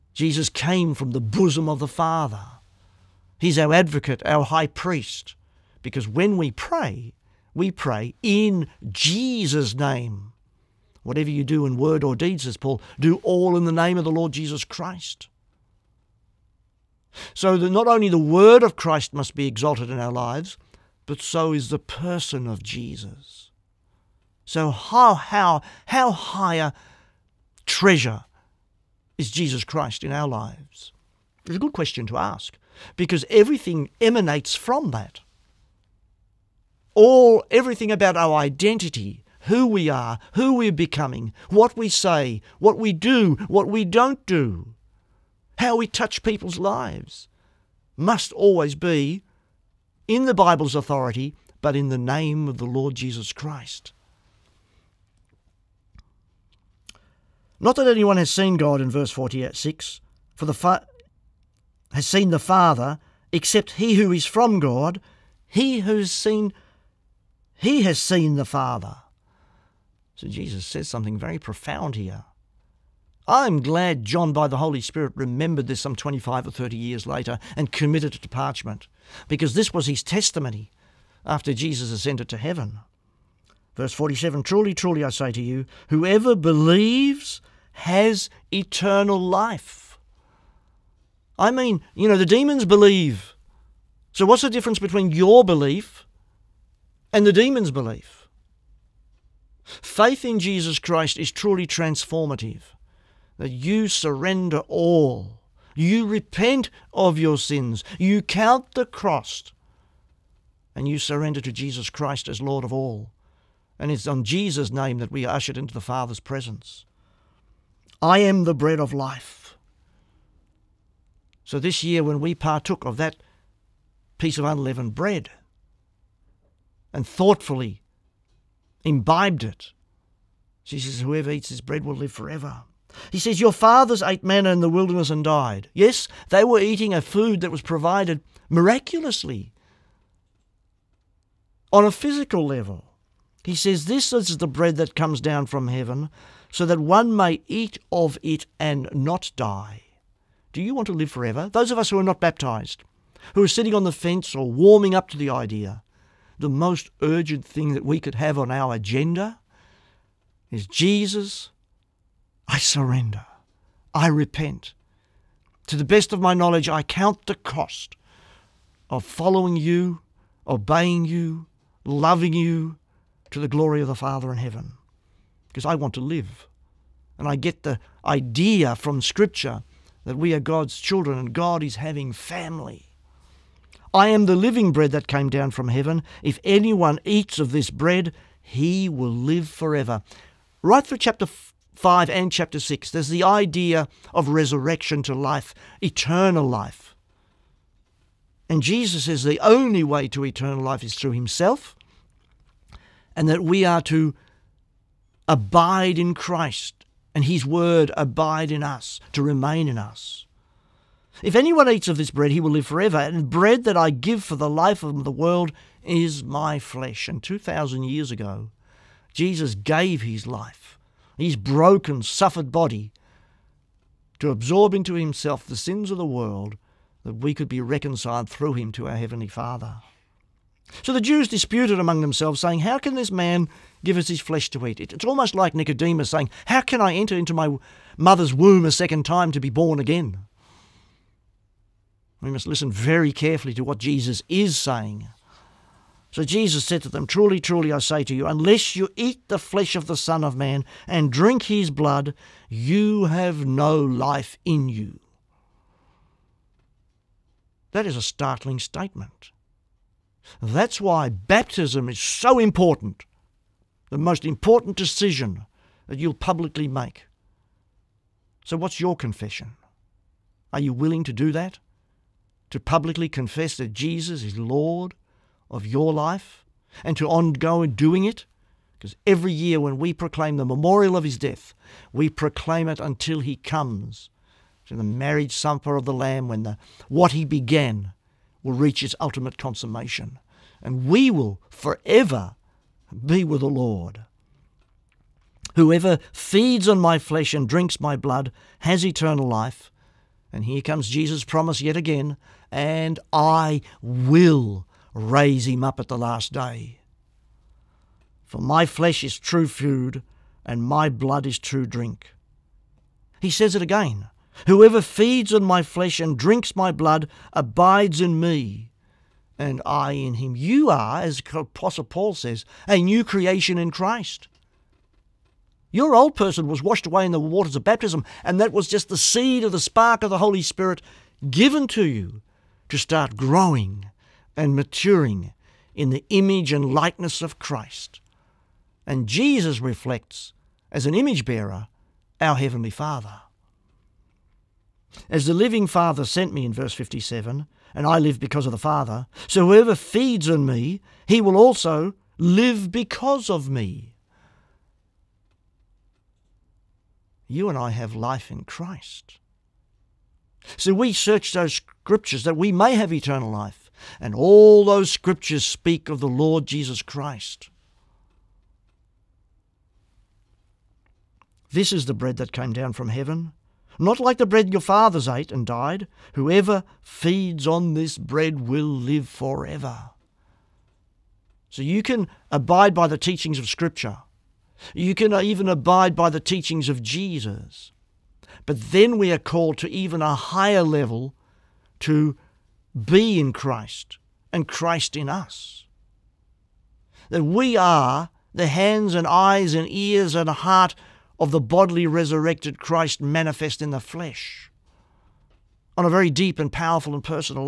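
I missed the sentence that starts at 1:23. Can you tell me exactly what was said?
Verse 47 Truly, truly, I say to you, whoever believes has eternal life.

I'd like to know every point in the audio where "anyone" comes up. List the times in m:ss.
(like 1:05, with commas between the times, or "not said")
0:57, 3:06, 3:31.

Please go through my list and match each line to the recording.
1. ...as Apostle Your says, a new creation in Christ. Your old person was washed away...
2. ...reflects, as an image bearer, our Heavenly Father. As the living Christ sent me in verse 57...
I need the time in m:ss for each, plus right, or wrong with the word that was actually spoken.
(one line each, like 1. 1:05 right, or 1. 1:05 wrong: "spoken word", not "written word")
1. 5:21 wrong: "Paul", not "Your"
2. 5:39 wrong: "Father", not "Christ".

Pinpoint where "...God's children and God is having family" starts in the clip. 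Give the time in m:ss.
3:00.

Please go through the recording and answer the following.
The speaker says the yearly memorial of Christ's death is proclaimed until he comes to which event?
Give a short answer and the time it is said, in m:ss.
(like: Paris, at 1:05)
Marriage supper of the Lamb, at 4:44.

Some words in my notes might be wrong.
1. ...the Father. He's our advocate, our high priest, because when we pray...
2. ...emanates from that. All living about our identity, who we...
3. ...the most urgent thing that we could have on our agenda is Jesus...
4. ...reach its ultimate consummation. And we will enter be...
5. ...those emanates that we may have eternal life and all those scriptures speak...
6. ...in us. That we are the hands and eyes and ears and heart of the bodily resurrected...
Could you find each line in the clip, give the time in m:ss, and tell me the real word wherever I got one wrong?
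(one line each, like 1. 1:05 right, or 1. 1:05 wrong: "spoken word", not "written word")
1. 0:01 right
2. 0:34 wrong: "everything", not "living"
3. 2:36 right
4. 4:48 wrong: "forever", not "enter"
5. 6:01 wrong: "scriptures", not "emanates"
6. 6:34 right.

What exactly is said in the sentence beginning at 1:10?
So Jesus says something very profound here.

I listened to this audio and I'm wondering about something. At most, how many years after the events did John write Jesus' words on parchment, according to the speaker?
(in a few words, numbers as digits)
30.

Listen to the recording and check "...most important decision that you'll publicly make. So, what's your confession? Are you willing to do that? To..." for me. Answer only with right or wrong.
right.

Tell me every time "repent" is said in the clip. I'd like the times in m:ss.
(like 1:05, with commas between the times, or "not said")
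1:46, 2:44.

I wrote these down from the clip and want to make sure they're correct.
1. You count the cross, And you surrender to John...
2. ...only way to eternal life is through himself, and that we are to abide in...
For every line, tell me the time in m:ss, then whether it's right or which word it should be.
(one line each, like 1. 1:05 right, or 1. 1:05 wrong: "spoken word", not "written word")
1. 1:47 wrong: "Jesus", not "John"
2. 3:19 right.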